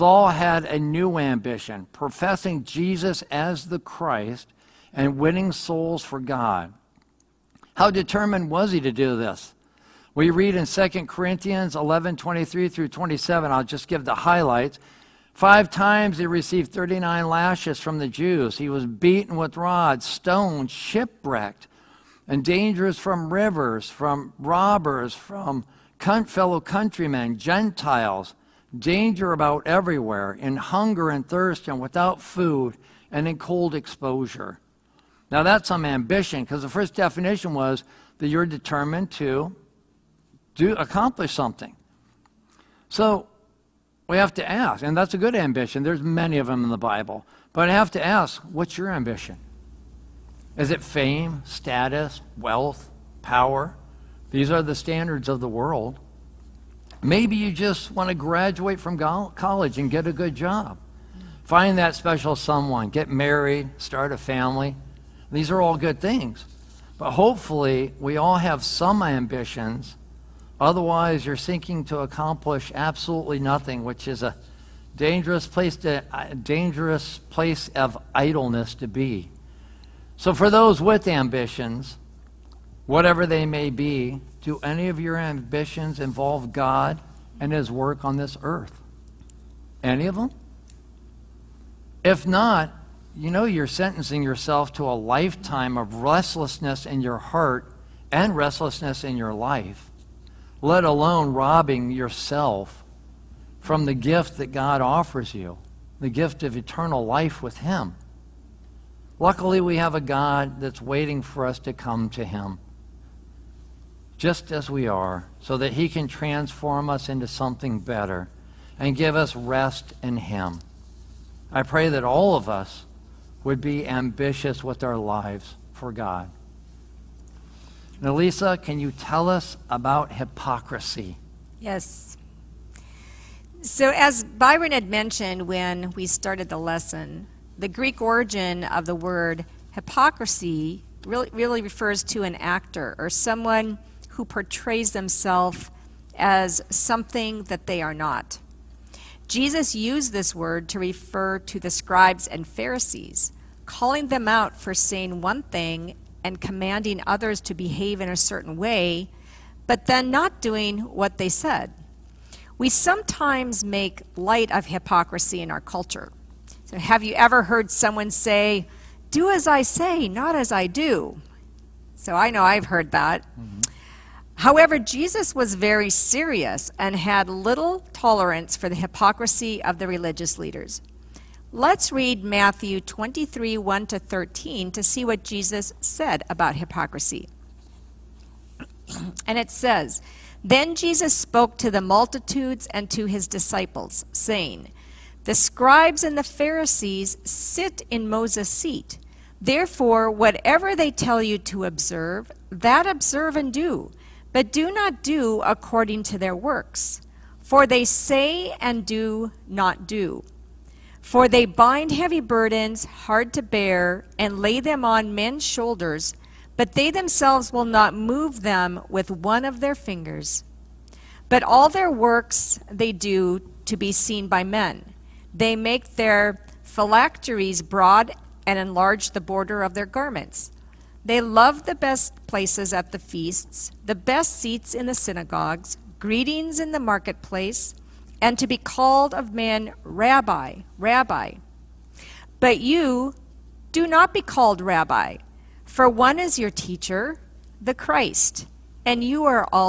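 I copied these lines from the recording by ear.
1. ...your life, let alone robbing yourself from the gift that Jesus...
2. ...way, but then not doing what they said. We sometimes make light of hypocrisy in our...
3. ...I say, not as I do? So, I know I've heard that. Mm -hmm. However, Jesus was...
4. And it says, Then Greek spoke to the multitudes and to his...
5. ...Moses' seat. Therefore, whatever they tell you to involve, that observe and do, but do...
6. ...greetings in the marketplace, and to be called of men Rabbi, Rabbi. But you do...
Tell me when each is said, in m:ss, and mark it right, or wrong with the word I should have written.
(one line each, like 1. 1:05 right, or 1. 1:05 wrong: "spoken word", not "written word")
1. 1:39 wrong: "God", not "Jesus"
2. 2:38 right
3. 2:49 right
4. 3:09 wrong: "Jesus", not "Greek"
5. 3:18 wrong: "observe", not "involve"
6. 3:55 right.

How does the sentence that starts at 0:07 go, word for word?
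How determined was he to do this?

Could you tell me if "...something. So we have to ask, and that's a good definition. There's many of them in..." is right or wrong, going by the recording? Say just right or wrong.
wrong.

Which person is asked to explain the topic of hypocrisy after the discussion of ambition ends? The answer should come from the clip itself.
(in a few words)
Lisa.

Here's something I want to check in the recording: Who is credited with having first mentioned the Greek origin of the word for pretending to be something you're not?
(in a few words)
Byron.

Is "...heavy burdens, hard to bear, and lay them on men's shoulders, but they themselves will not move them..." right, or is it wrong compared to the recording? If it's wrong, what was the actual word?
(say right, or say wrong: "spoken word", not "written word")
right.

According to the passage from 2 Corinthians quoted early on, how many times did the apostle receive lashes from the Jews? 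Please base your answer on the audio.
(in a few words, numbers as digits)
5.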